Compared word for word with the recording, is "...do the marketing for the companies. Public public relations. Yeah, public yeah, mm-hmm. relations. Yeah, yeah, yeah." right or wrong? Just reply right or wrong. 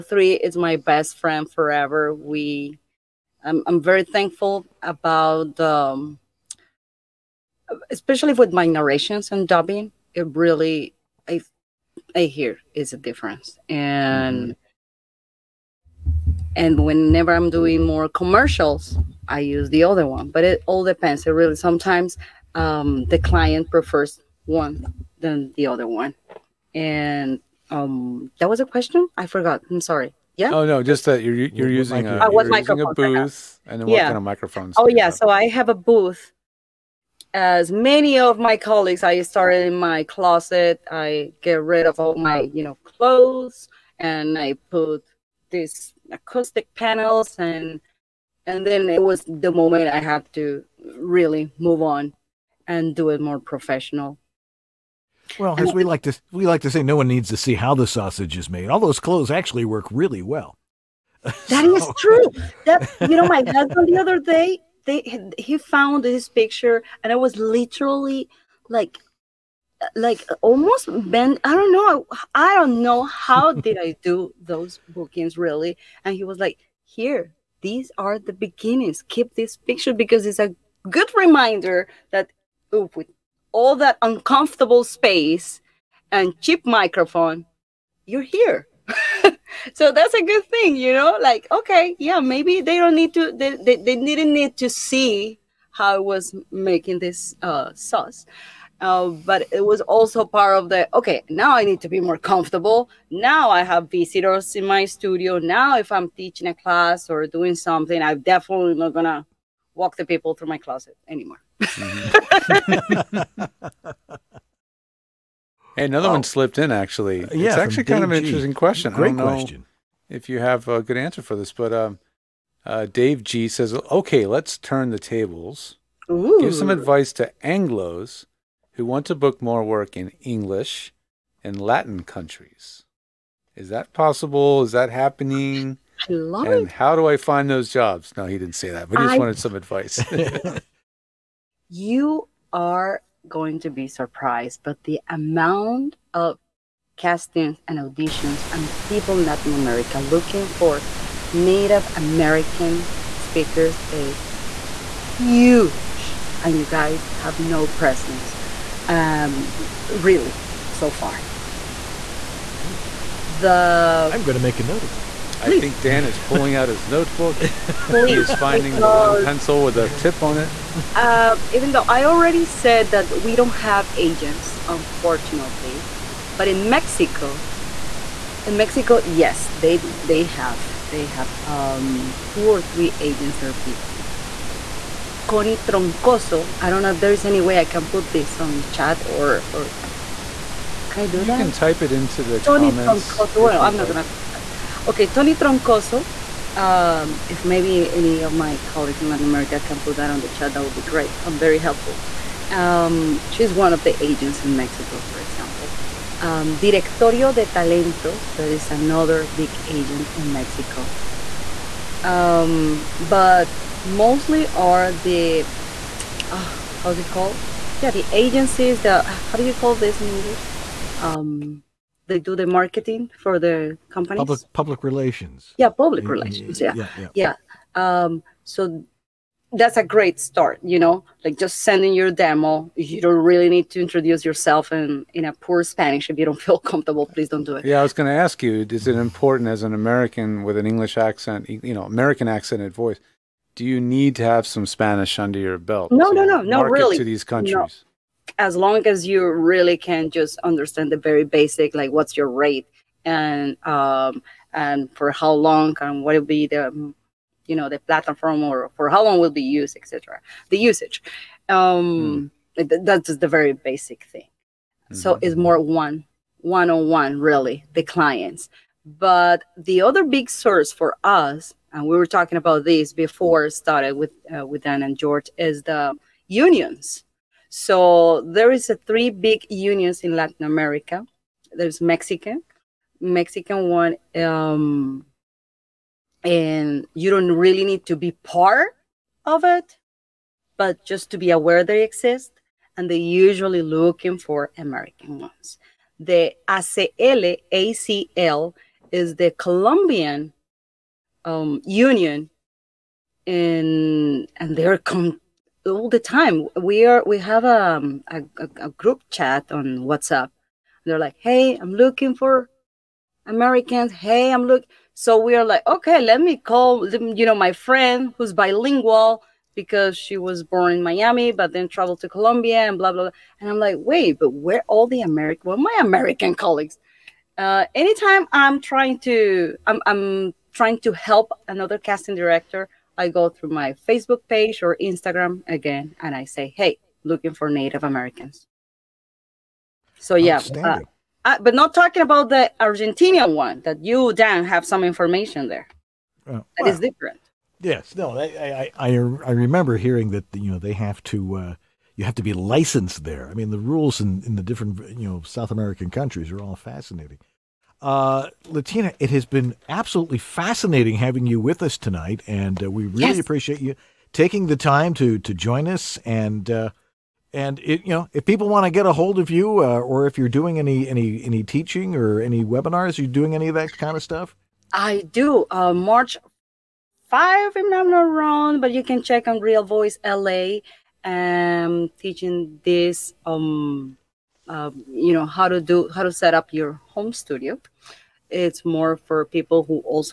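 right.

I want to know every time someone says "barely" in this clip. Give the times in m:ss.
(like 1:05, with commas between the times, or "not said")
not said.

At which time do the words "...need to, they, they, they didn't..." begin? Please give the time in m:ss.
1:32.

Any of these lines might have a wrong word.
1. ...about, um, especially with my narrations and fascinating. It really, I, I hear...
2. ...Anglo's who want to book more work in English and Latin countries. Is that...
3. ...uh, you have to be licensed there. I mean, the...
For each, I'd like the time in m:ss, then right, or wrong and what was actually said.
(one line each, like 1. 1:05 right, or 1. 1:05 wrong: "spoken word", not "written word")
1. 0:04 wrong: "dubbing", not "fascinating"
2. 2:07 right
3. 5:51 right.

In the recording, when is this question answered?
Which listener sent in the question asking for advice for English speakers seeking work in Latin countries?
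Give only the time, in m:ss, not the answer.
2:02.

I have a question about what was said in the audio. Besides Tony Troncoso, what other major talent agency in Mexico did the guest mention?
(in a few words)
Directorio de Talentos.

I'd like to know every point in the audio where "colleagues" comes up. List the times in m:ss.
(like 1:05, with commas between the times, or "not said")
0:38, 3:18, 5:26.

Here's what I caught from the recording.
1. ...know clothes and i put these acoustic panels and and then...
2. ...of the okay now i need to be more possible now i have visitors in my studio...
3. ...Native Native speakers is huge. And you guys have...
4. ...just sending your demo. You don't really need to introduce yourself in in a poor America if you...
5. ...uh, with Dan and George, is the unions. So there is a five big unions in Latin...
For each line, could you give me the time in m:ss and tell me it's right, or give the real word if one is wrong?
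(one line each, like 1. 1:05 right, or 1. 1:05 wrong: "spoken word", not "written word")
1. 0:42 right
2. 1:40 wrong: "comfortable", not "possible"
3. 2:31 wrong: "American", not "Native"
4. 3:51 wrong: "Spanish", not "America"
5. 4:34 wrong: "three", not "five".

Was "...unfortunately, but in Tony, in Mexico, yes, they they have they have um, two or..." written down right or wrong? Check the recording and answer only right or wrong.
wrong.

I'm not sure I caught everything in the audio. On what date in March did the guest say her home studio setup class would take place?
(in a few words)
March 5.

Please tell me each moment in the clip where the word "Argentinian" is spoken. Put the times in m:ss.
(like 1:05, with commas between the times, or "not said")
5:42.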